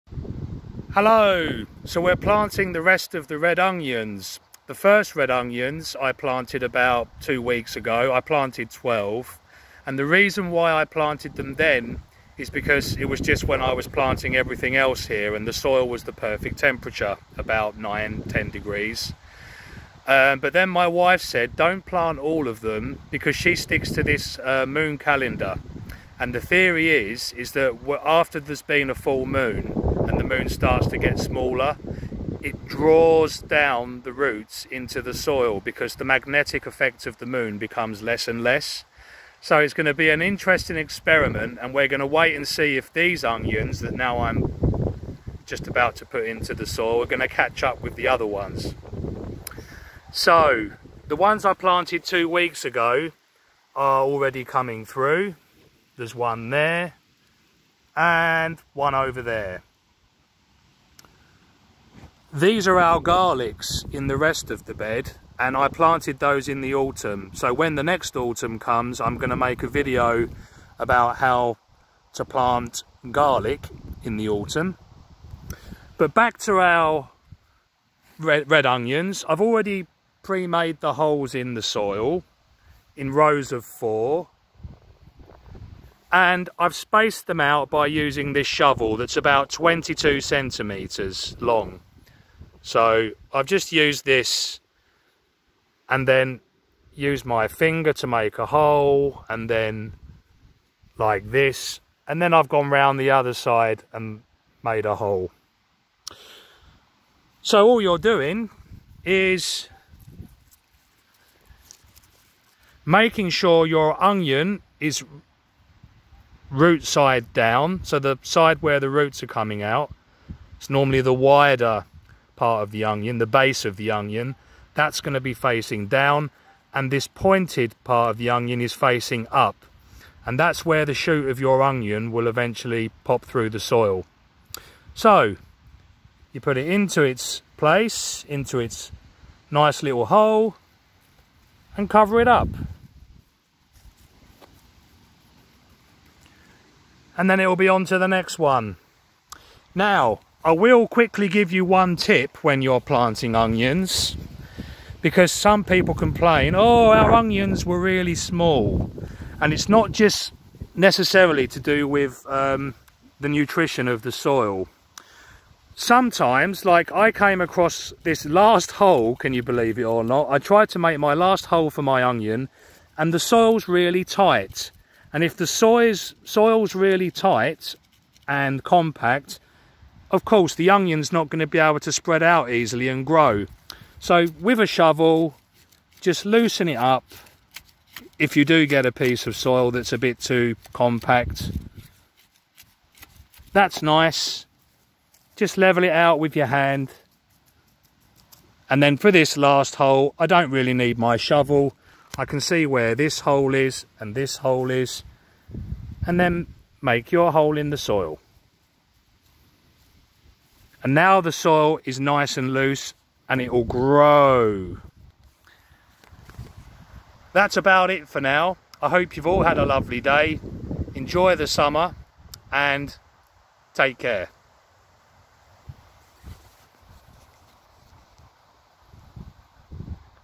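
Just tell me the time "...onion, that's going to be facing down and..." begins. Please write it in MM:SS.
02:03.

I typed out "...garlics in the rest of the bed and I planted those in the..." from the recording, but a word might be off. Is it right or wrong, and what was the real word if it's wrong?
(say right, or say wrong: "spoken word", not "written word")
right.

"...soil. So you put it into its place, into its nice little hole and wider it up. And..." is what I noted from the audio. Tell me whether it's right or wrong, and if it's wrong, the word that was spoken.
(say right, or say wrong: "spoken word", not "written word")
wrong: "cover", not "wider".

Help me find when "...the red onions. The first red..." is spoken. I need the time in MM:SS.
00:03.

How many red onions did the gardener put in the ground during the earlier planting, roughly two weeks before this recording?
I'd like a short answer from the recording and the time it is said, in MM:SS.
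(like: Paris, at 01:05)
12, at 00:08.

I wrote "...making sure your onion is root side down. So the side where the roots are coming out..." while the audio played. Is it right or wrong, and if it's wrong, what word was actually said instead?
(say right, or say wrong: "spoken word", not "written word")
right.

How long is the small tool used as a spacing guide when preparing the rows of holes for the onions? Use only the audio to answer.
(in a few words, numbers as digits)
22 centimeters.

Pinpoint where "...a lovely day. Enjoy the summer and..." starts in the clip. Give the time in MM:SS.
03:39.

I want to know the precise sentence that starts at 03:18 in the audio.
And then for this last hole, I don't really need my shovel.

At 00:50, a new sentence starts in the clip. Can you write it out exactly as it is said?
So the ones I planted two weeks ago are already coming through.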